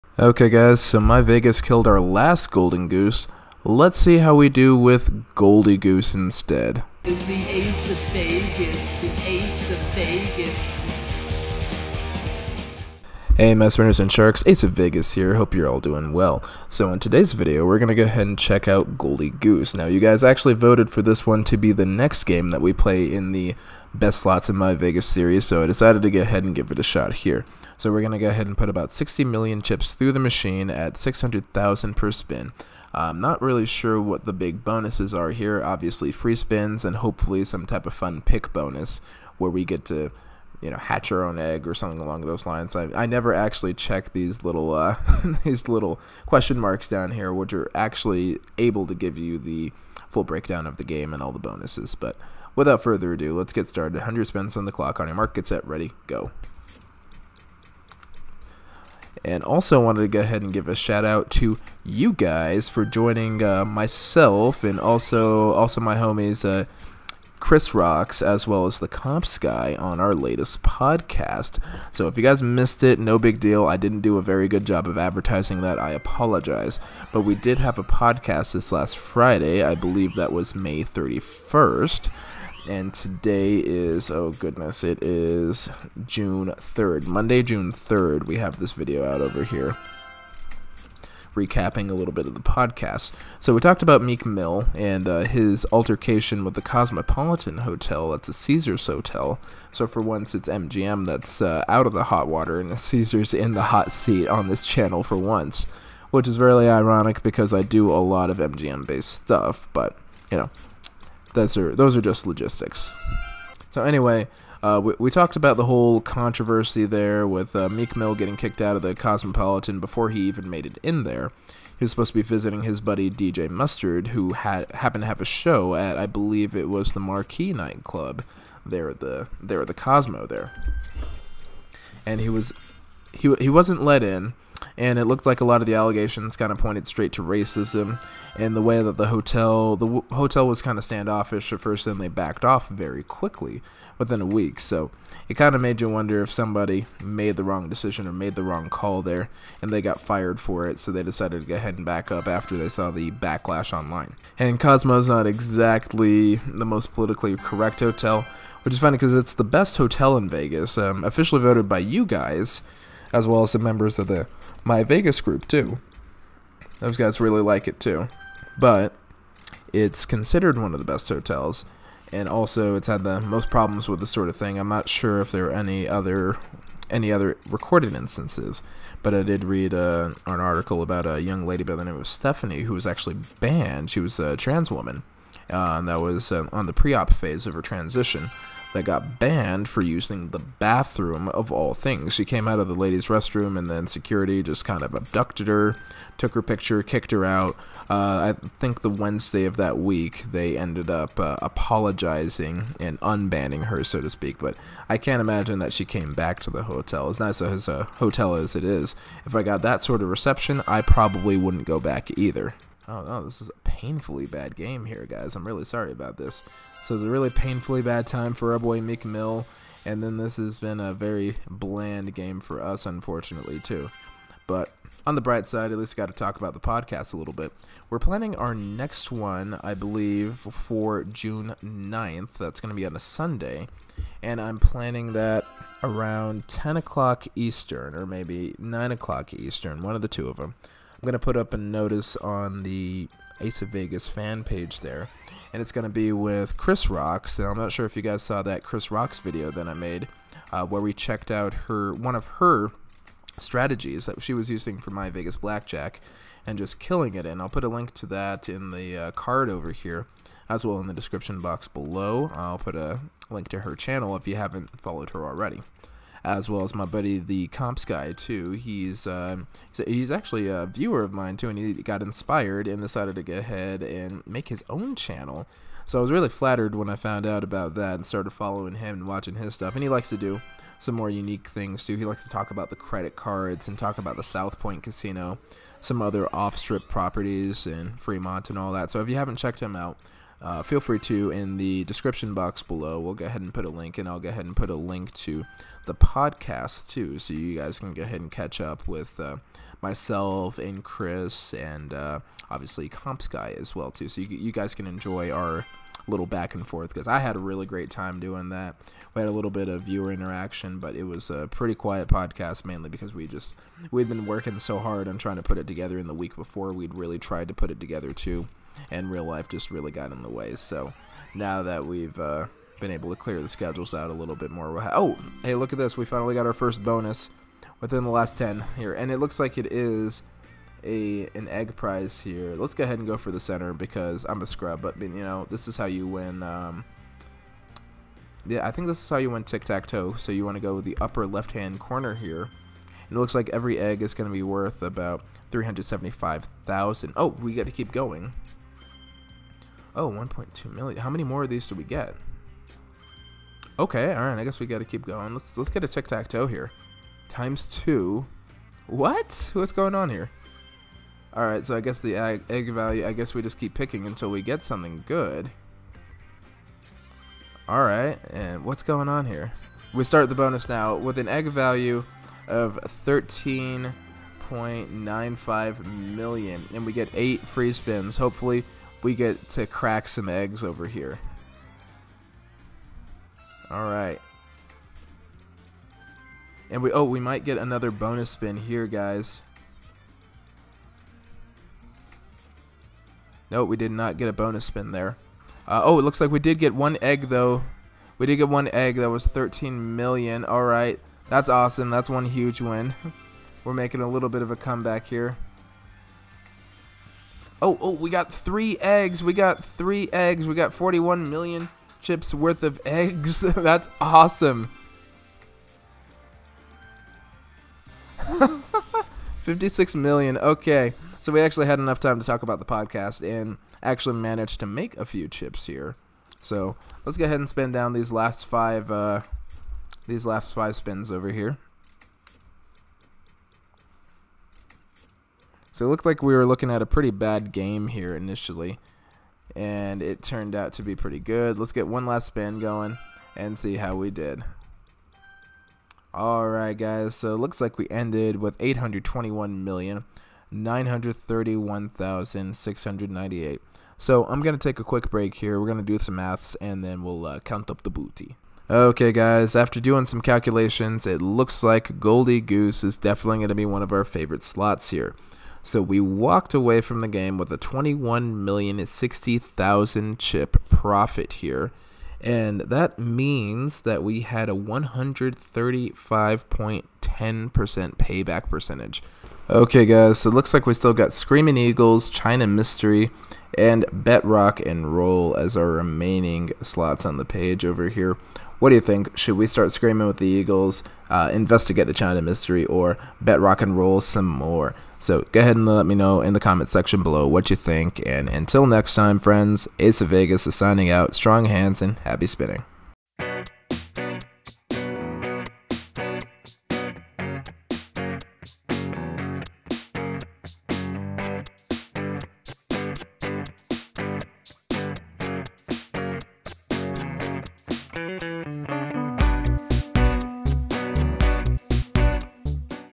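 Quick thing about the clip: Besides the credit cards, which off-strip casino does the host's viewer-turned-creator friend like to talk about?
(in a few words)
South Point Casino.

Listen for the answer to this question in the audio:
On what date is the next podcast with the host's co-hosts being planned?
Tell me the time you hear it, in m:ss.
3:51.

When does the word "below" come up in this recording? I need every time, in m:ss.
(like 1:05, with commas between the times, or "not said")
4:21, 4:52, 8:17.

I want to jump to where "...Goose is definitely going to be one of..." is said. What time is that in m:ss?
7:42.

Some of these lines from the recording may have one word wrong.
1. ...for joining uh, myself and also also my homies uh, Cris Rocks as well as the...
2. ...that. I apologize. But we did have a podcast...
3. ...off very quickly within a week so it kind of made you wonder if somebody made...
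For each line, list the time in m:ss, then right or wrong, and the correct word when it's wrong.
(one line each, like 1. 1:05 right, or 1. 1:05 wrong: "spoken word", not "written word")
1. 1:02 right
2. 1:15 right
3. 2:22 right.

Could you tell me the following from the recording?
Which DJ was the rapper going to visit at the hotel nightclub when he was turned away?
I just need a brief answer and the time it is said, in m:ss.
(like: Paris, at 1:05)
DJ Mustard, at 2:03.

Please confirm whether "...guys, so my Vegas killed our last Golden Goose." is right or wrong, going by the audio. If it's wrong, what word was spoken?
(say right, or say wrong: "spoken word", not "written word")
right.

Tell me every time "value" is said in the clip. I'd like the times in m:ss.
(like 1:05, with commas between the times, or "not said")
6:02, 6:11.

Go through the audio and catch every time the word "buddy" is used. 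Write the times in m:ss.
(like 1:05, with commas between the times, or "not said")
2:02, 4:26.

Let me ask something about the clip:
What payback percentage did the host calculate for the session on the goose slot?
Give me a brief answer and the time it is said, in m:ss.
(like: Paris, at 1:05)
135.10%, at 7:54.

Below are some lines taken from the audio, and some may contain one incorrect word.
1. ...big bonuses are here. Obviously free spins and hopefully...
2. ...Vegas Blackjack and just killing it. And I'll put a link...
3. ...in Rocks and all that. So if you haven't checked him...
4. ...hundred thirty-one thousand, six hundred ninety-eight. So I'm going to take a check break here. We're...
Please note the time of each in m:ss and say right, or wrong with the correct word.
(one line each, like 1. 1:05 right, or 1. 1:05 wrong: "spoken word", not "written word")
1. 0:34 right
2. 4:15 right
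3. 4:47 wrong: "Fremont", not "Rocks"
4. 7:30 wrong: "quick", not "check".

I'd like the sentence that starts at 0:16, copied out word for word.
So in today's video, we're going to go ahead and check out Goldie Goose.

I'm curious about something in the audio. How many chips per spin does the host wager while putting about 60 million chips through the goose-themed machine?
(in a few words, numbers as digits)
600,000.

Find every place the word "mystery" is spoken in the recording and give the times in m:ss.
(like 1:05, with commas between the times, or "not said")
8:02, 8:12.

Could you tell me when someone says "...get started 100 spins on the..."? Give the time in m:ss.
0:53.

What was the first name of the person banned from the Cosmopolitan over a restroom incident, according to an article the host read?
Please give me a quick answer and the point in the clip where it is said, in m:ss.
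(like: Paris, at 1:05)
Stephanie, at 3:02.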